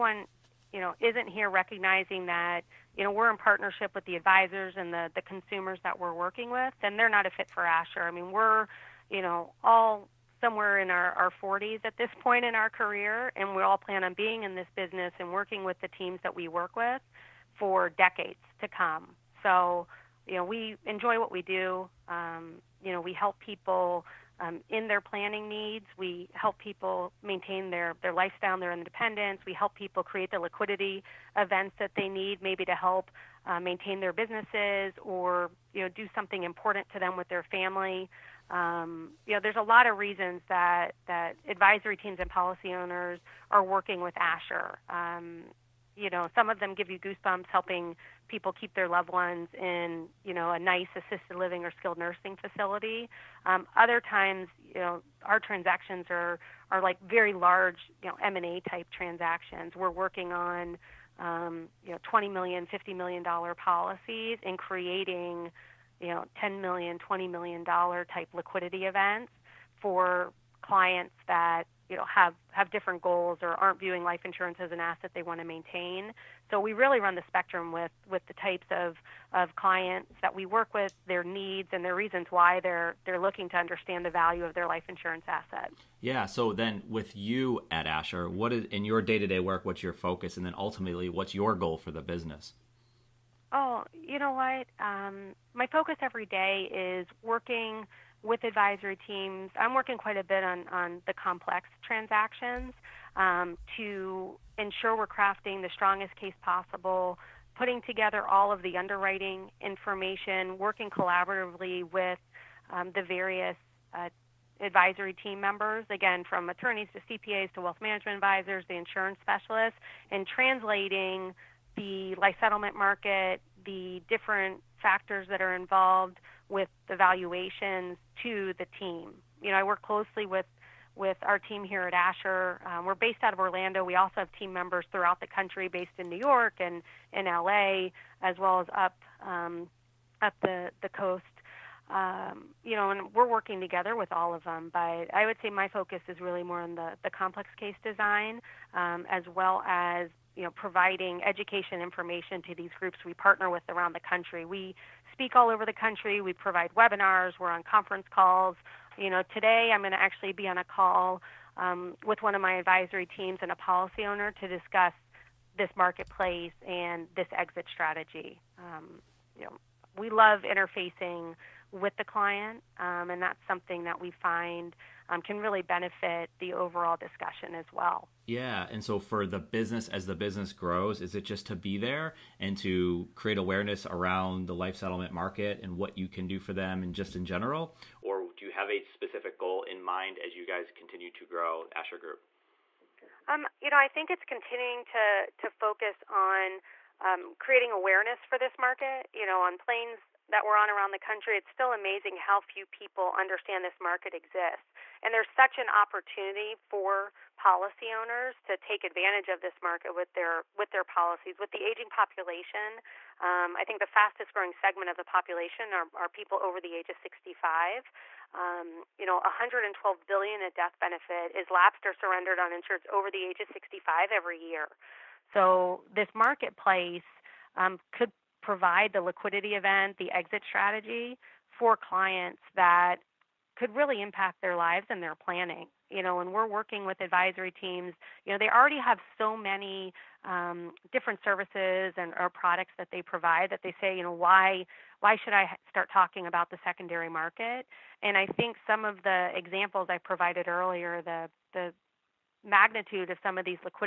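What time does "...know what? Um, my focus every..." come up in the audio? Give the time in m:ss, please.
1:34.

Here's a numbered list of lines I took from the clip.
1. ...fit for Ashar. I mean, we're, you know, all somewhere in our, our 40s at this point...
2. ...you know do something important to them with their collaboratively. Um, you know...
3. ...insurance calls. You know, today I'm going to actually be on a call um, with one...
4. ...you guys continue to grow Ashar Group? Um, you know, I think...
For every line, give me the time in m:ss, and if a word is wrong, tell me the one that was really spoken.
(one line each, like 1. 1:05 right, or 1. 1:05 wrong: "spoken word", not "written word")
1. 0:07 right
2. 0:35 wrong: "family", not "collaboratively"
3. 2:37 wrong: "conference", not "insurance"
4. 3:10 right.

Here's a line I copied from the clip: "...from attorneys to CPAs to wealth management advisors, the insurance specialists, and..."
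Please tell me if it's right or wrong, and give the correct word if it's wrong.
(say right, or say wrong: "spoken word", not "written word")
right.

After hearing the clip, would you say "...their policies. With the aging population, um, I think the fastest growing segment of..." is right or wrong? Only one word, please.
right.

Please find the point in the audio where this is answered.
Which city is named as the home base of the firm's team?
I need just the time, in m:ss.
2:13.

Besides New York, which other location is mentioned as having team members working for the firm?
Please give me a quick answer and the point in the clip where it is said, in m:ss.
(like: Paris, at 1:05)
LA, at 2:17.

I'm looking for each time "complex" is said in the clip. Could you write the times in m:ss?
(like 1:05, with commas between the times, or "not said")
1:41, 2:27.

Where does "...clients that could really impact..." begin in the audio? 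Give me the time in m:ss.
3:51.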